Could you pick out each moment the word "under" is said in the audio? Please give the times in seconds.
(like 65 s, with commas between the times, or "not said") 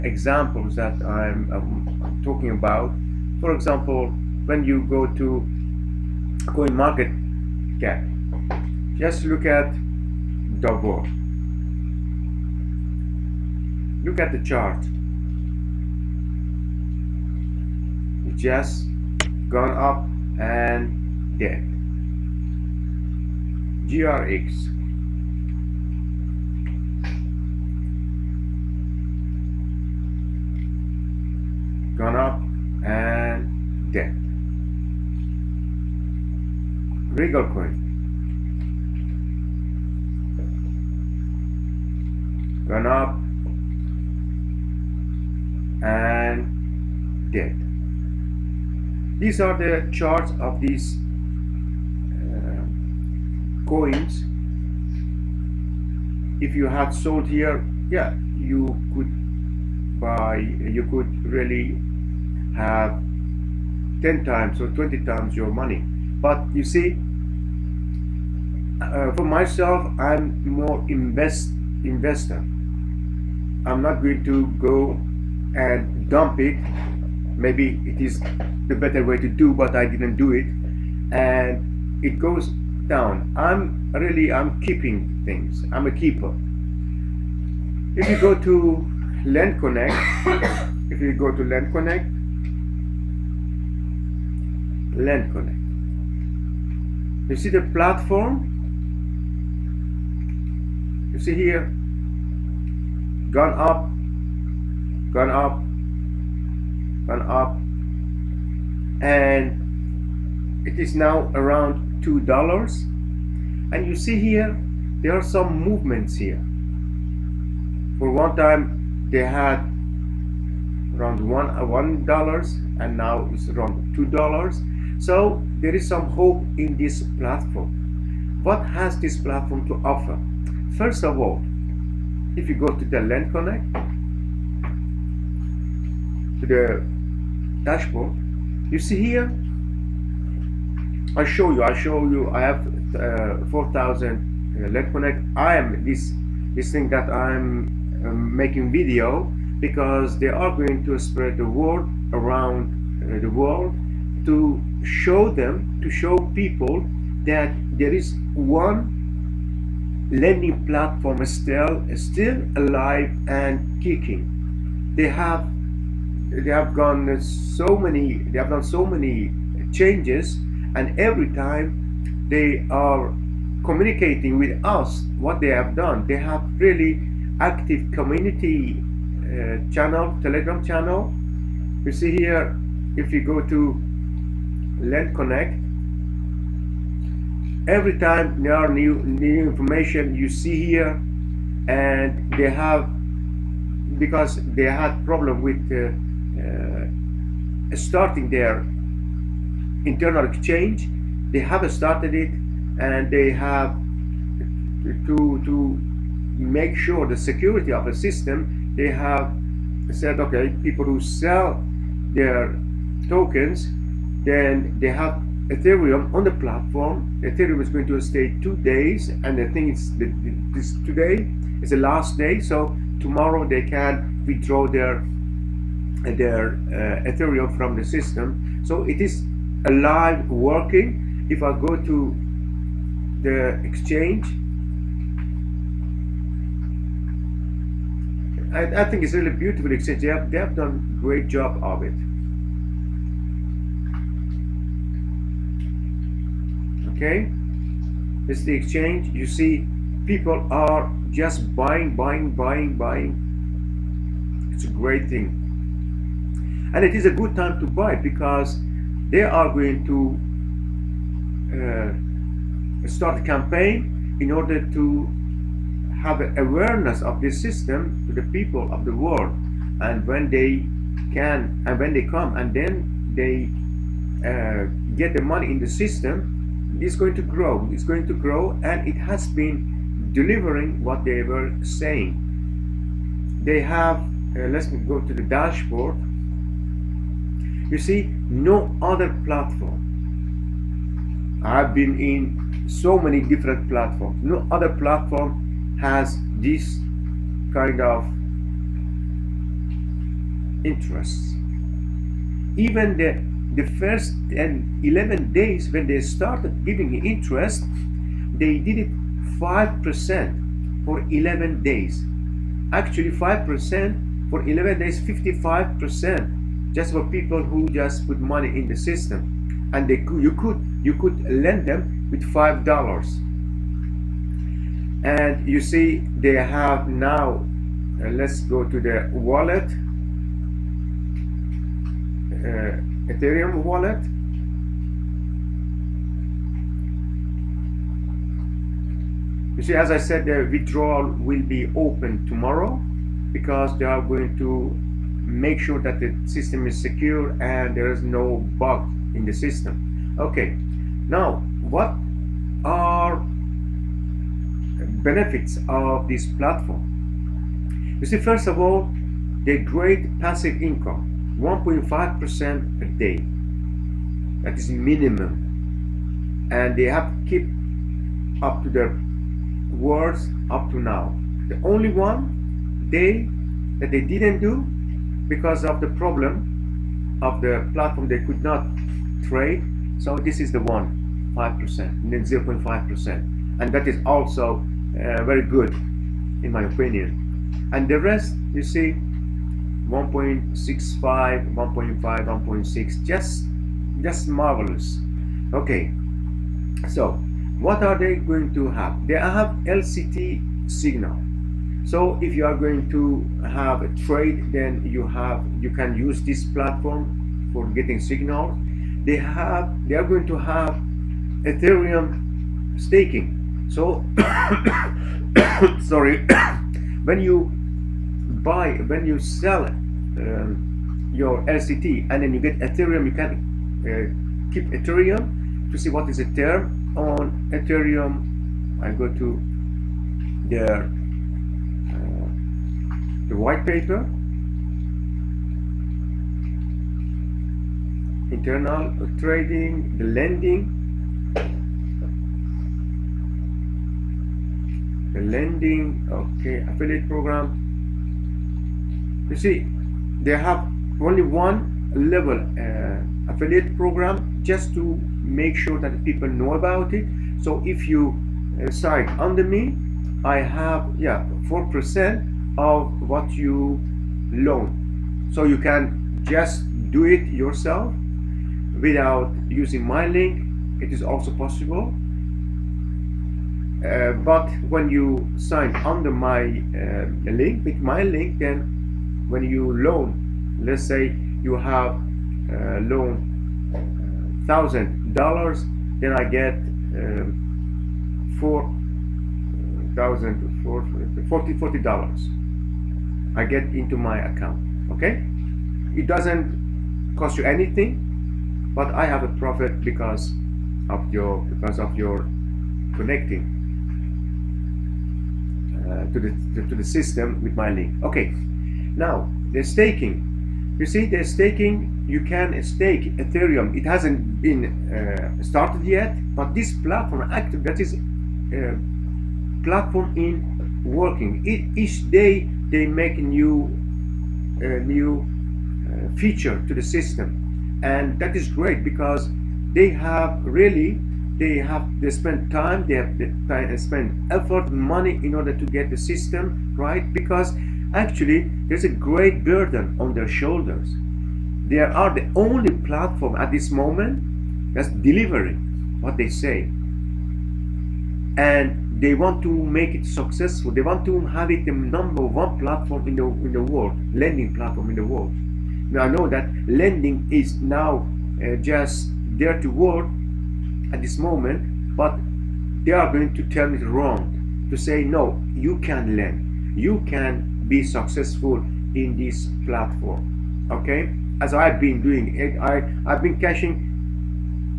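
459 s, 475 s.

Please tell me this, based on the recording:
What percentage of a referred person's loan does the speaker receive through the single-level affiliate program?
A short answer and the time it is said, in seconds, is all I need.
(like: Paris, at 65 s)
4%, at 461 s.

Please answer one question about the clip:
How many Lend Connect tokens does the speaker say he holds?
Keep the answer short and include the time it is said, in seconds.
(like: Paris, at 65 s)
4,000, at 143 s.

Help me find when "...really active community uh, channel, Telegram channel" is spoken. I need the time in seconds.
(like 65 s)
176 s.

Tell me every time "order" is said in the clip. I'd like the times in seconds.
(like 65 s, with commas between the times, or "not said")
264 s, 535 s.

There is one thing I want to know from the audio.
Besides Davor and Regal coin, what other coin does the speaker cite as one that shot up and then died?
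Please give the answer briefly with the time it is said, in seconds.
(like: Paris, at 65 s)
GRX, at 23 s.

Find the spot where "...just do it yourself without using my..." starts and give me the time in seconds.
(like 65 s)
466 s.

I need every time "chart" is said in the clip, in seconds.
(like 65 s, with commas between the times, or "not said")
14 s, 49 s.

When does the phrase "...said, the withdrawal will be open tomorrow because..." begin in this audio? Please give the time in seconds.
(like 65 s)
339 s.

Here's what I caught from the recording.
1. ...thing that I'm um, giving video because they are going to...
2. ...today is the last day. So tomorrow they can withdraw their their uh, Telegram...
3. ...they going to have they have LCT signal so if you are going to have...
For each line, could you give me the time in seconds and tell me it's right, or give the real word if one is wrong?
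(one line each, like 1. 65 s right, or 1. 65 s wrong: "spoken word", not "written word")
1. 146 s wrong: "making", not "giving"
2. 220 s wrong: "Ethereum", not "Telegram"
3. 397 s right.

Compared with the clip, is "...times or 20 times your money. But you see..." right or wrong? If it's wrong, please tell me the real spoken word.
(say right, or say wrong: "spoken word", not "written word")
right.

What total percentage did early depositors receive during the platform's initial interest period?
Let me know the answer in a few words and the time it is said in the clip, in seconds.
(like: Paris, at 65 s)
55%, at 315 s.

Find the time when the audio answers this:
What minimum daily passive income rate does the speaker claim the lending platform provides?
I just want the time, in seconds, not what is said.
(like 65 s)
361 s.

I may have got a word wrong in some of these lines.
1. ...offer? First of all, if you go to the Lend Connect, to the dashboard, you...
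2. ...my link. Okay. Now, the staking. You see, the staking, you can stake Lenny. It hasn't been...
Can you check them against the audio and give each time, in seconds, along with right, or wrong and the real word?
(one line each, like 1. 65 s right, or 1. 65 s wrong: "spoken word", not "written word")
1. 129 s right
2. 507 s wrong: "Ethereum", not "Lenny".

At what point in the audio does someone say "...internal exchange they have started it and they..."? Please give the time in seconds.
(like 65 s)
199 s.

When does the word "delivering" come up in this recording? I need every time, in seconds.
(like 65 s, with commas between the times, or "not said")
280 s, 544 s.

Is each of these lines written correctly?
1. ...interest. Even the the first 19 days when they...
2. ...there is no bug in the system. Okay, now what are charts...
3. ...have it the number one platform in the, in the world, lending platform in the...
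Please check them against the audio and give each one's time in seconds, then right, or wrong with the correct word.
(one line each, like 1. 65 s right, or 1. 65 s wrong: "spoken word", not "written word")
1. 300 s wrong: "11", not "19"
2. 347 s wrong: "benefits", not "charts"
3. 551 s right.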